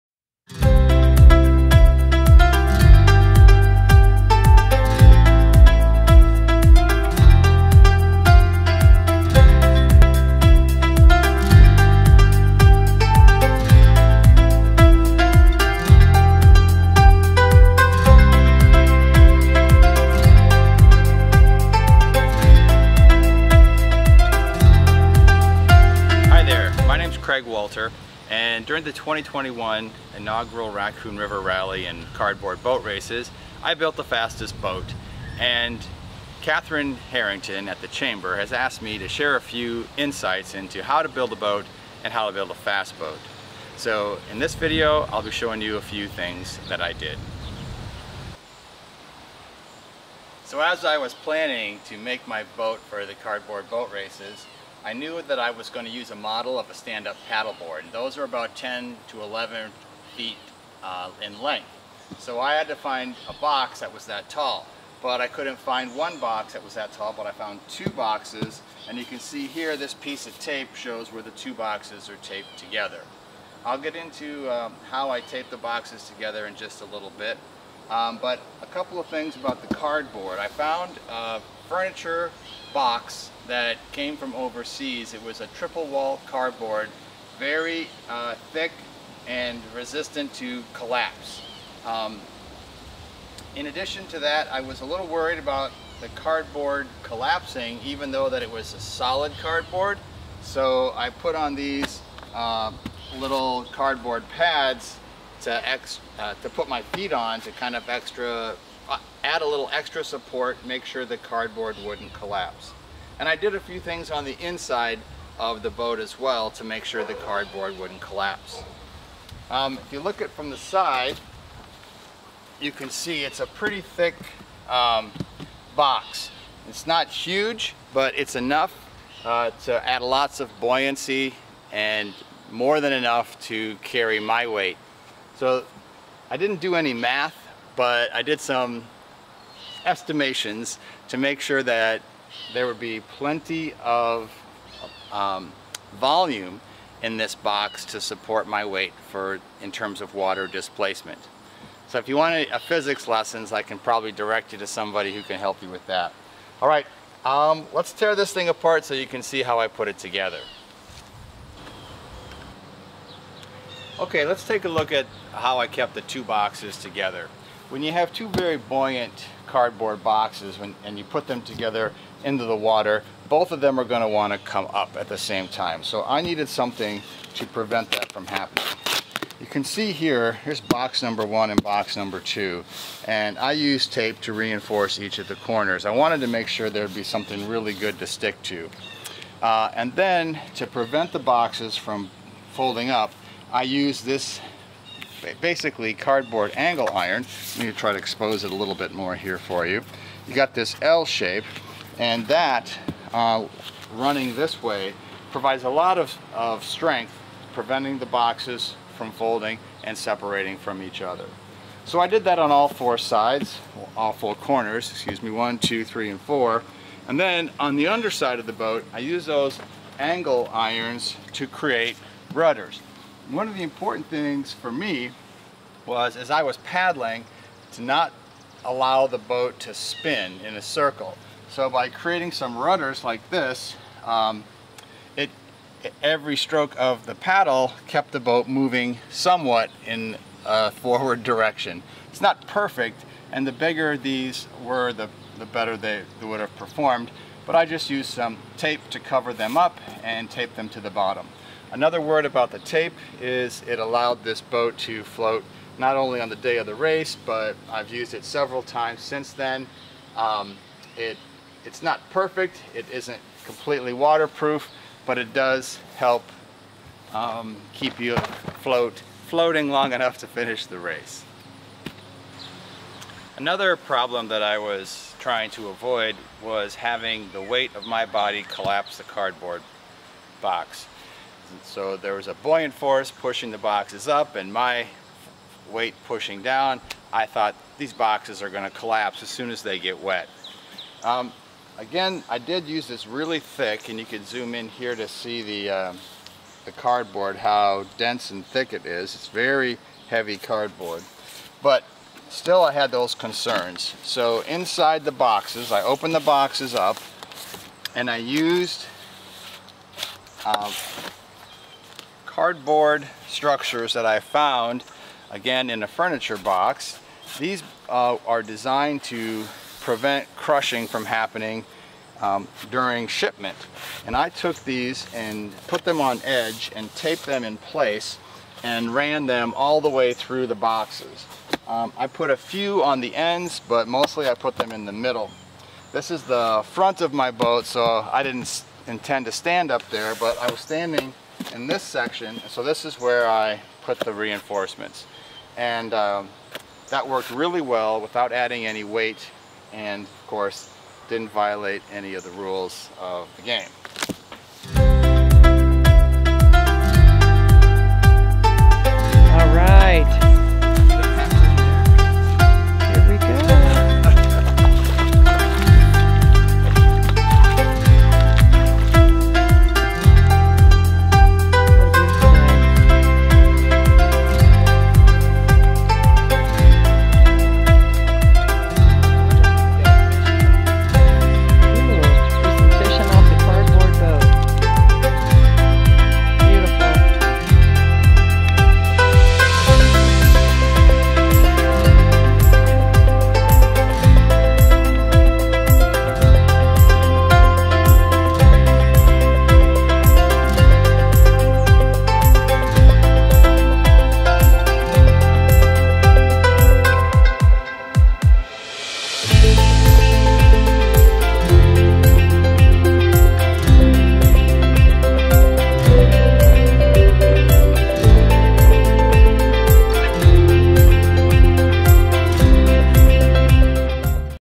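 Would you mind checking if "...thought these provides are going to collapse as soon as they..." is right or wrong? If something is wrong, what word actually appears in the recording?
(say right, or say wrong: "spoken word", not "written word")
wrong: "boxes", not "provides".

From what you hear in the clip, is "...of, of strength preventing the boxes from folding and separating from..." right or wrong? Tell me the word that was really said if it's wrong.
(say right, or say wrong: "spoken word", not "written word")
right.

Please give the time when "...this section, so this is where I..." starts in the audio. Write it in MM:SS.
05:41.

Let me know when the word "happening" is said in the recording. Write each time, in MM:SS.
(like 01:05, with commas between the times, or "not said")
02:58, 05:21.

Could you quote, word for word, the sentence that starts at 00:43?
So in this video, I'll be showing you a few things that I did.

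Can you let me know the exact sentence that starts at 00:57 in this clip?
those are about 10 to 11 feet uh, in length.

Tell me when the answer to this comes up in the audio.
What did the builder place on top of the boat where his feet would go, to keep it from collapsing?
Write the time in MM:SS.
01:43.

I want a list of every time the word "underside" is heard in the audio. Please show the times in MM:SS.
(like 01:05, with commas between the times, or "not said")
03:37.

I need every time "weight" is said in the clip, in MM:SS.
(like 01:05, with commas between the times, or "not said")
02:14, 02:28, 04:37, 04:45, 05:48.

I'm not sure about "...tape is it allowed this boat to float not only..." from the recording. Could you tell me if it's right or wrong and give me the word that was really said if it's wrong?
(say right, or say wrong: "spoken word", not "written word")
right.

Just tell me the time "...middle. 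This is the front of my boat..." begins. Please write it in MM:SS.
05:34.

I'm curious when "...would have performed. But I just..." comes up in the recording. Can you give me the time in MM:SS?
04:06.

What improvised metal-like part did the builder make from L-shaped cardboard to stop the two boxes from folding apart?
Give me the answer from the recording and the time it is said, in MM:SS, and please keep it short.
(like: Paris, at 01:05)
cardboard angle iron, at 03:15.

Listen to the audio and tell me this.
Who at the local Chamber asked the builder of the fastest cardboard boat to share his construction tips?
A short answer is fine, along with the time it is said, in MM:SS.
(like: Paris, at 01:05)
Catherine Harrington, at 00:36.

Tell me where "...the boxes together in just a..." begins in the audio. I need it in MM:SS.
01:15.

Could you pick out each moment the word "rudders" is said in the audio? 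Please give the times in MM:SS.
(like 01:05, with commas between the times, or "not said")
03:42, 03:52.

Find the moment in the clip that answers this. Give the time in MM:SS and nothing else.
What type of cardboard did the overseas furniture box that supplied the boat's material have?
01:25.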